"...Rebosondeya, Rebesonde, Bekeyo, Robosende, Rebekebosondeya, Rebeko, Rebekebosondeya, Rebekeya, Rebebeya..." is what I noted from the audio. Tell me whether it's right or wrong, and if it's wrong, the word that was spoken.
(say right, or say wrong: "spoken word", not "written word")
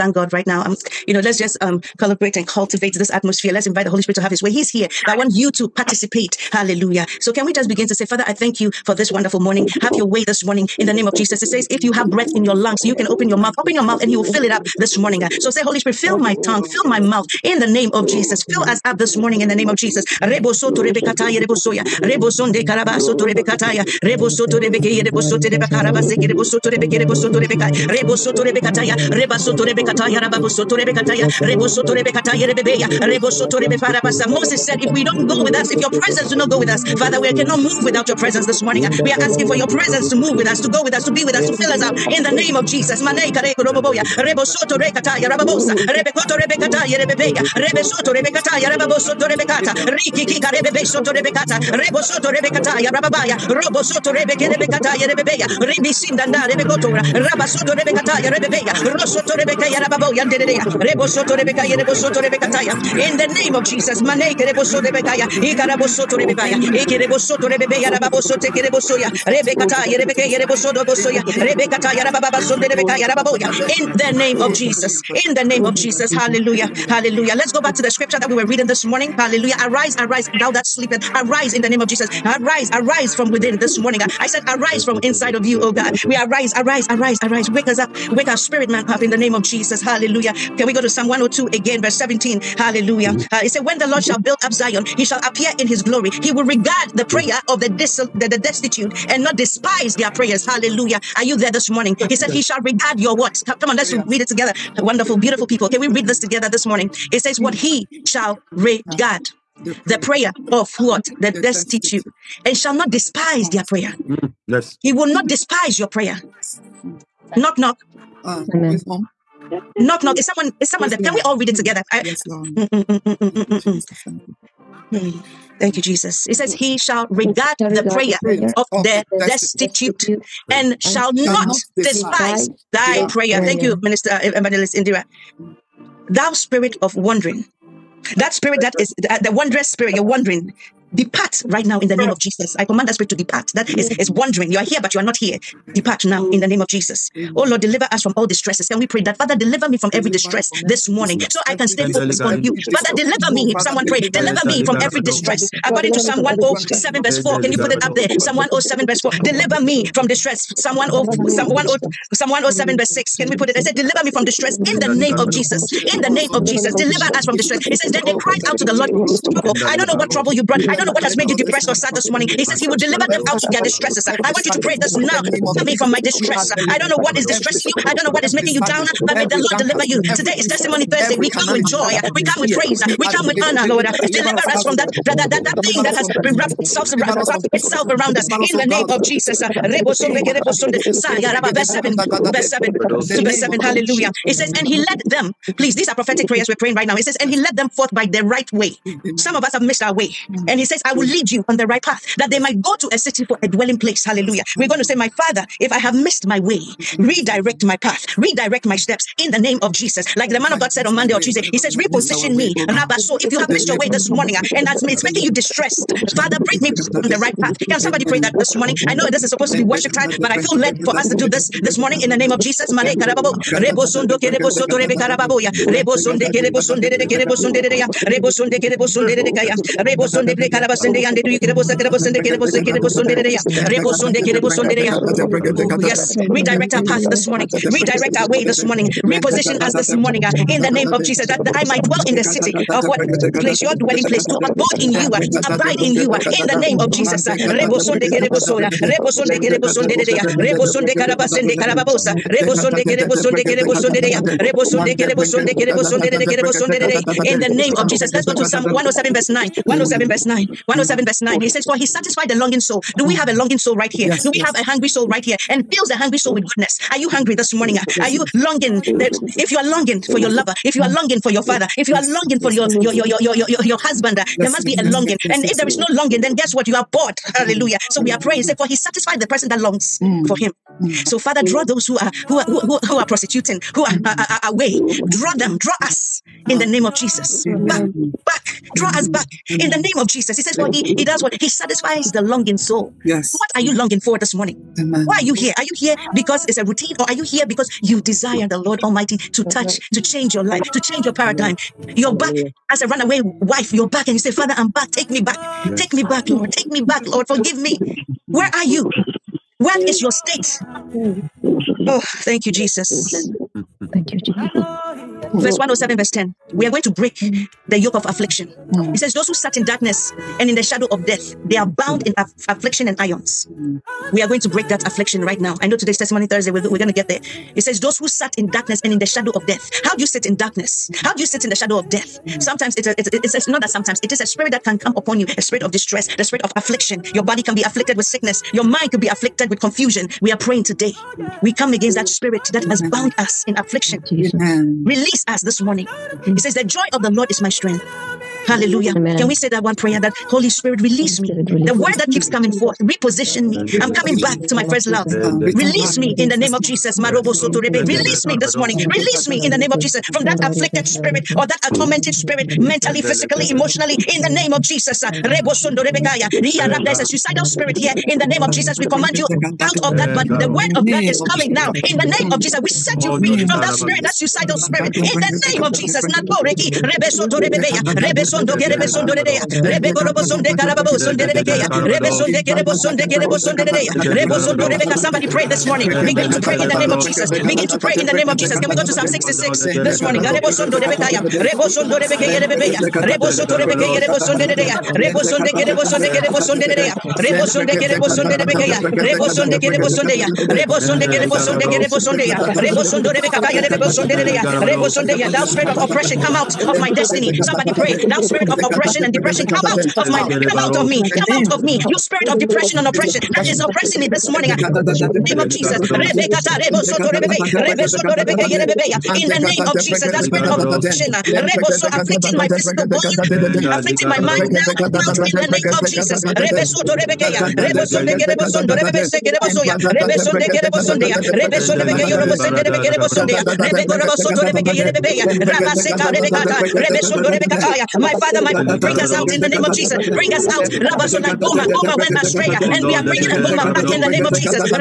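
wrong: "Robosoto", not "Rebekebosondeya".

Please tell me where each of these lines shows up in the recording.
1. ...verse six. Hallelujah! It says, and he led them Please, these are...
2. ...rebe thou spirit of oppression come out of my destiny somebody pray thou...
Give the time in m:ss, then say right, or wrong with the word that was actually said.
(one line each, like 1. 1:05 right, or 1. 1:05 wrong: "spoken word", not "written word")
1. 3:13 wrong: "seven", not "six"
2. 6:43 right.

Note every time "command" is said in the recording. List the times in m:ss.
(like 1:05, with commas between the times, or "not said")
2:22, 6:08.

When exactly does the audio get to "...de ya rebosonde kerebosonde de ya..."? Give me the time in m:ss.
3:53.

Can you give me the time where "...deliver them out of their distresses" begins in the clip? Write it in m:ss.
2:52.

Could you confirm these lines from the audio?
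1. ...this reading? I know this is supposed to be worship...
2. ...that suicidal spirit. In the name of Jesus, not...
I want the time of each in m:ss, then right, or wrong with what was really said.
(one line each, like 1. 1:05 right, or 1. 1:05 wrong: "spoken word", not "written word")
1. 3:38 wrong: "morning", not "reading"
2. 6:14 right.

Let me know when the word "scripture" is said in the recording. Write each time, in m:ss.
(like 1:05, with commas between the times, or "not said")
1:17.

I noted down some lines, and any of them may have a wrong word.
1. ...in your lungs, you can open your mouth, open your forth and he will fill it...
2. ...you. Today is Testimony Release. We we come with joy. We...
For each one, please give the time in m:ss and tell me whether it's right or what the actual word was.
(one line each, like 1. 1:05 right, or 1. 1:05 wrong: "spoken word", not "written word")
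1. 0:12 wrong: "mouth", not "forth"
2. 2:59 wrong: "Thursday", not "Release".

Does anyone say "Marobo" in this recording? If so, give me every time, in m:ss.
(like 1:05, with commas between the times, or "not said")
5:56.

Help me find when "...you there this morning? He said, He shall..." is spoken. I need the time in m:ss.
1:41.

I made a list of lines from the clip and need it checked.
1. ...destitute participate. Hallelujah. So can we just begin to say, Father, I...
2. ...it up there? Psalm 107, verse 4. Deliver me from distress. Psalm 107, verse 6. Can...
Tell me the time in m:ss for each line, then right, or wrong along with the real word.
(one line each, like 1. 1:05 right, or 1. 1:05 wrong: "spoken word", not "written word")
1. 0:05 wrong: "participate", not "destitute"
2. 2:37 right.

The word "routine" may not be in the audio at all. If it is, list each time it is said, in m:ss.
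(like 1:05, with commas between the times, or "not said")
4:56.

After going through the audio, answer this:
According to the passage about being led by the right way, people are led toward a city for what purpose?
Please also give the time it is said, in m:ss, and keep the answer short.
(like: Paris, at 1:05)
a dwelling place, at 3:23.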